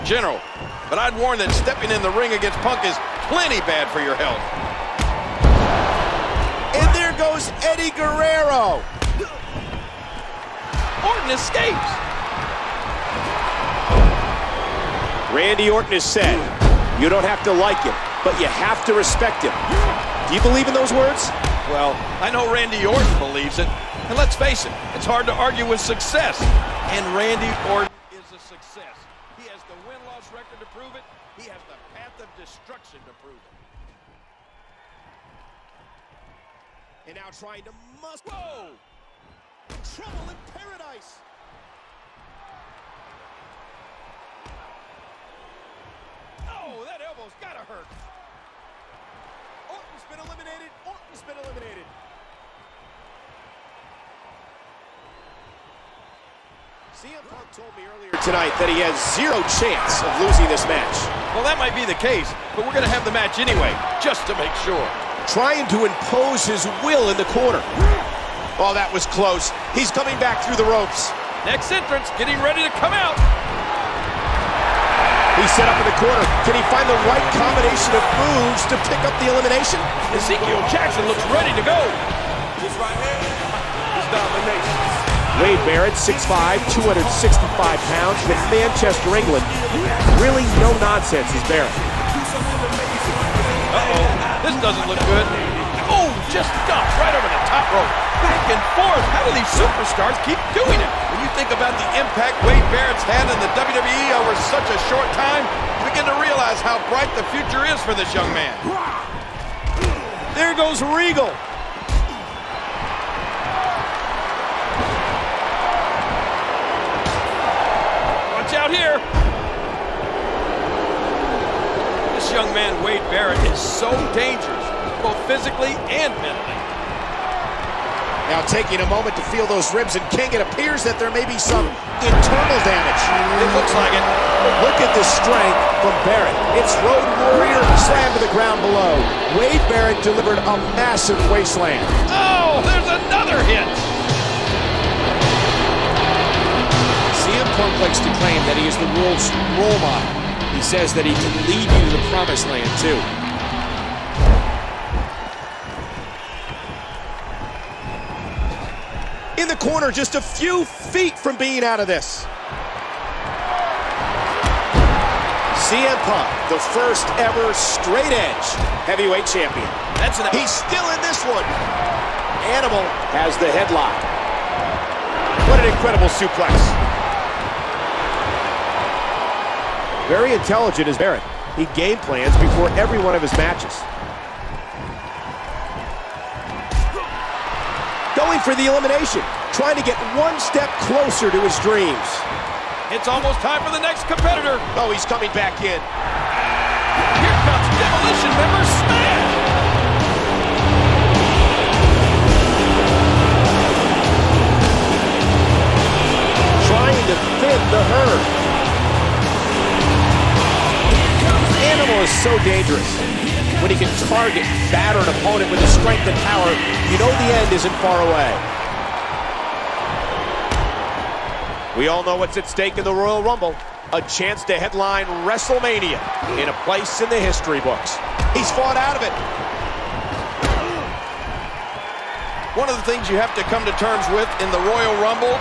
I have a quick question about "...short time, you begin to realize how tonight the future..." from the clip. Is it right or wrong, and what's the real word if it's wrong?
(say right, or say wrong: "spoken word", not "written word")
wrong: "bright", not "tonight".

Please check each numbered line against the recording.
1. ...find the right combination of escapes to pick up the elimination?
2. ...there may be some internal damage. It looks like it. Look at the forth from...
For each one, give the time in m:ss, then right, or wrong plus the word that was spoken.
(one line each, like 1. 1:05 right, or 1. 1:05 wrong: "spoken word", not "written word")
1. 1:16 wrong: "moves", not "escapes"
2. 2:10 wrong: "strength", not "forth".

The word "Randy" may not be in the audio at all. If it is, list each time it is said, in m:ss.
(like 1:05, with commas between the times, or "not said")
0:15, 0:22, 0:27.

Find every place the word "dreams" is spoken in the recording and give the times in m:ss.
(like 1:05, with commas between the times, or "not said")
3:11.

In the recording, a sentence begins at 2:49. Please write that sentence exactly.
That's an He's still in this one.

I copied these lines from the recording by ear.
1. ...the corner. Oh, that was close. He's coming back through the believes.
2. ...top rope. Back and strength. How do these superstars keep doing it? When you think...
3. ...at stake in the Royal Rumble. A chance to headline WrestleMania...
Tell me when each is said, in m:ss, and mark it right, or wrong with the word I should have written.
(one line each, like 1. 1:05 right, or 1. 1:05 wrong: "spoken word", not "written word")
1. 1:07 wrong: "ropes", not "believes"
2. 1:37 wrong: "forth", not "strength"
3. 3:42 right.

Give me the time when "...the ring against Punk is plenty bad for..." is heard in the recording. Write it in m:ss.
0:02.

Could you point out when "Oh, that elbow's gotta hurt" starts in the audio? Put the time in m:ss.
0:46.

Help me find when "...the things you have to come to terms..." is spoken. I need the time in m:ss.
3:52.